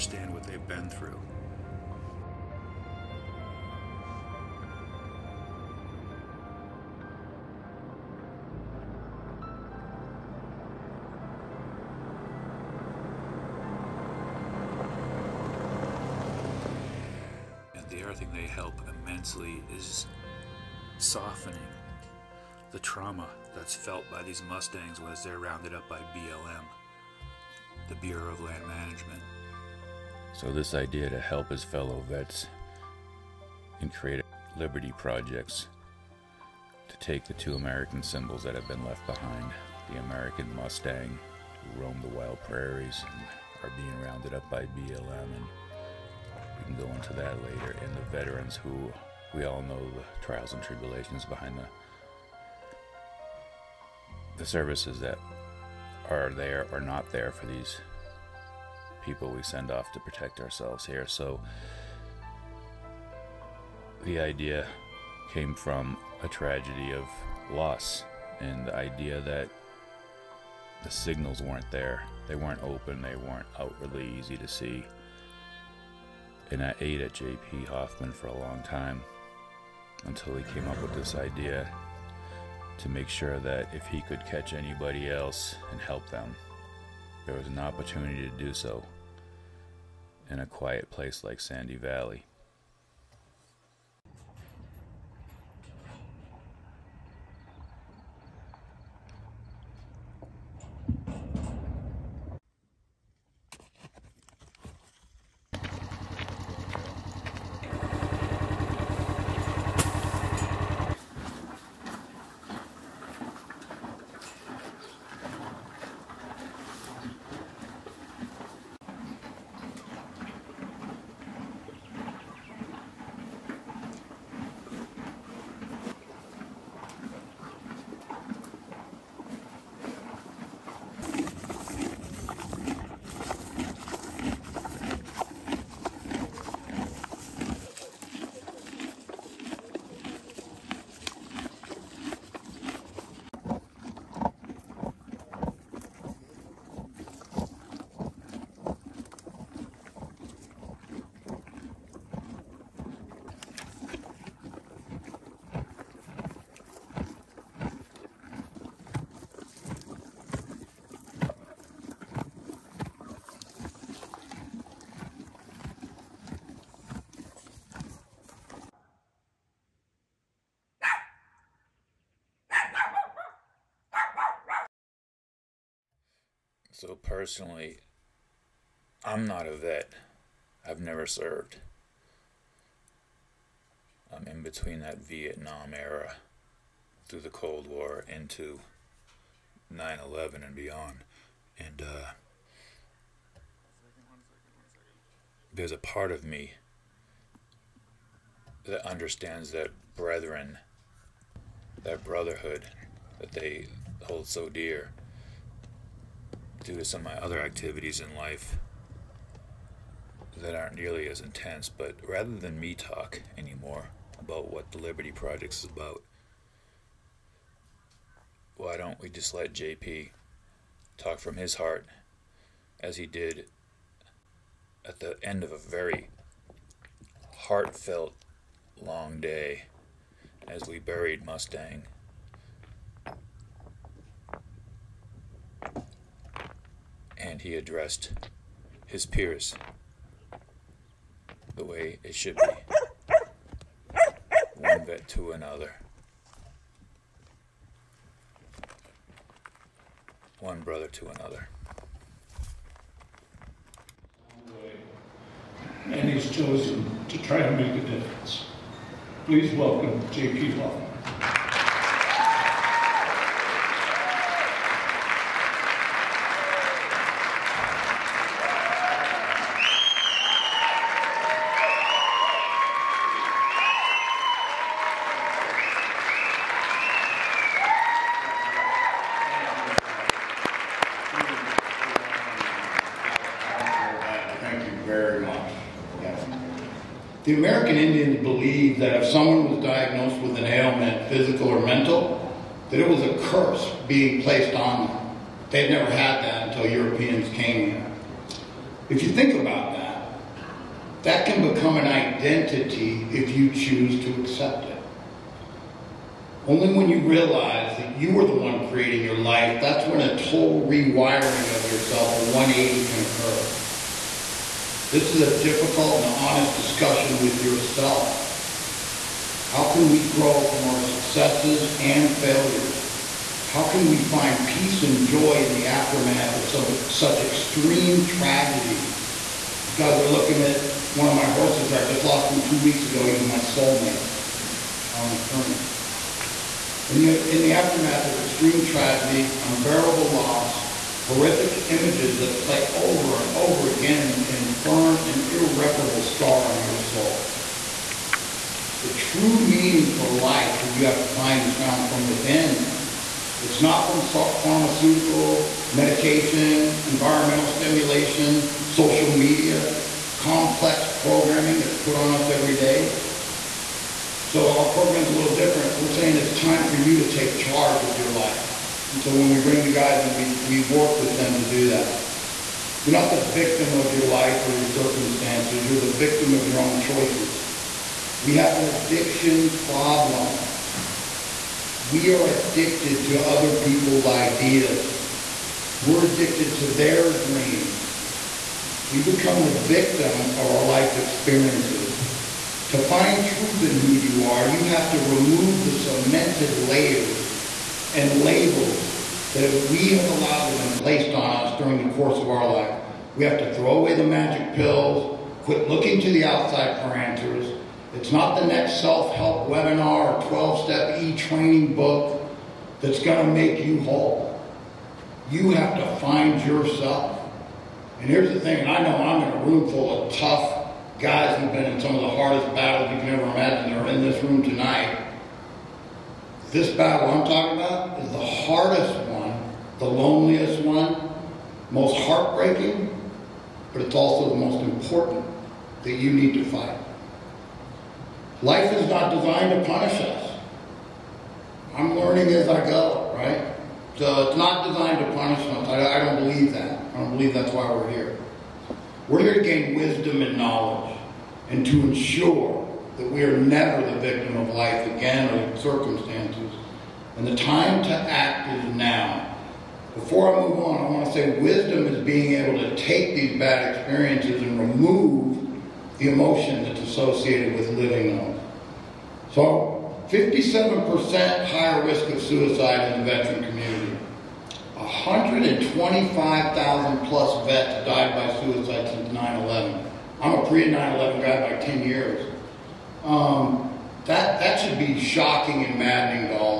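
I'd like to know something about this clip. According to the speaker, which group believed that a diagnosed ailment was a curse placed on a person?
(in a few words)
American Indians.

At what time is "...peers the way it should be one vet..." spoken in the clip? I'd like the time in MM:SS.
03:59.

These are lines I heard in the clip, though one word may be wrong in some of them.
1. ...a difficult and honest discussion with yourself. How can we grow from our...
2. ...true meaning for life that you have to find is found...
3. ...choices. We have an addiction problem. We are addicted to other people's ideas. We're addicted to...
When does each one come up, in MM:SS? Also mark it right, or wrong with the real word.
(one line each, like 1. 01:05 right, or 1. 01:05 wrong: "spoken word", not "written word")
1. 05:15 right
2. 05:48 right
3. 06:16 right.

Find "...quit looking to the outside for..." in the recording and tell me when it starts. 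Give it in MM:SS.
06:45.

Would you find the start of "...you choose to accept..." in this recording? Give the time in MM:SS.
05:03.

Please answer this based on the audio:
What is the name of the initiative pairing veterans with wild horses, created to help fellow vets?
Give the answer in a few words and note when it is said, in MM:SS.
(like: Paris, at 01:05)
Liberty Project, at 03:34.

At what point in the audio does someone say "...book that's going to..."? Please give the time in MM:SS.
06:51.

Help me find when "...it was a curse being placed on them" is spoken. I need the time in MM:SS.
04:52.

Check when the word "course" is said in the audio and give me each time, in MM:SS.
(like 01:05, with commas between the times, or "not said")
06:41.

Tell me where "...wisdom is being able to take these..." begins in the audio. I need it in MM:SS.
07:41.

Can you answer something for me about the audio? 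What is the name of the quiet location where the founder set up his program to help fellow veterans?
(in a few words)
Sandy Valley.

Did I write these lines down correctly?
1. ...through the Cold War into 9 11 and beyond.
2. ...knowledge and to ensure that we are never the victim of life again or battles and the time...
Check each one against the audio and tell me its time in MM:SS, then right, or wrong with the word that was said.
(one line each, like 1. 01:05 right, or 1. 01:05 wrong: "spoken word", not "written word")
1. 03:07 right
2. 07:30 wrong: "circumstances", not "battles".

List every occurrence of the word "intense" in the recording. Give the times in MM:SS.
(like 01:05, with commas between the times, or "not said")
03:31.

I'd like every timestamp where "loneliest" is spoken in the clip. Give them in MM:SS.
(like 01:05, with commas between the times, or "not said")
07:09.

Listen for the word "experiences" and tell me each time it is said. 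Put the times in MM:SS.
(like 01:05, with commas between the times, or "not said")
06:30, 07:43.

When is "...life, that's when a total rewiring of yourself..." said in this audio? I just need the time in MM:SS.
05:09.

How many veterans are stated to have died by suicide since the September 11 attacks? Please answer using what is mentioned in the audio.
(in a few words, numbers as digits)
125,000 plus.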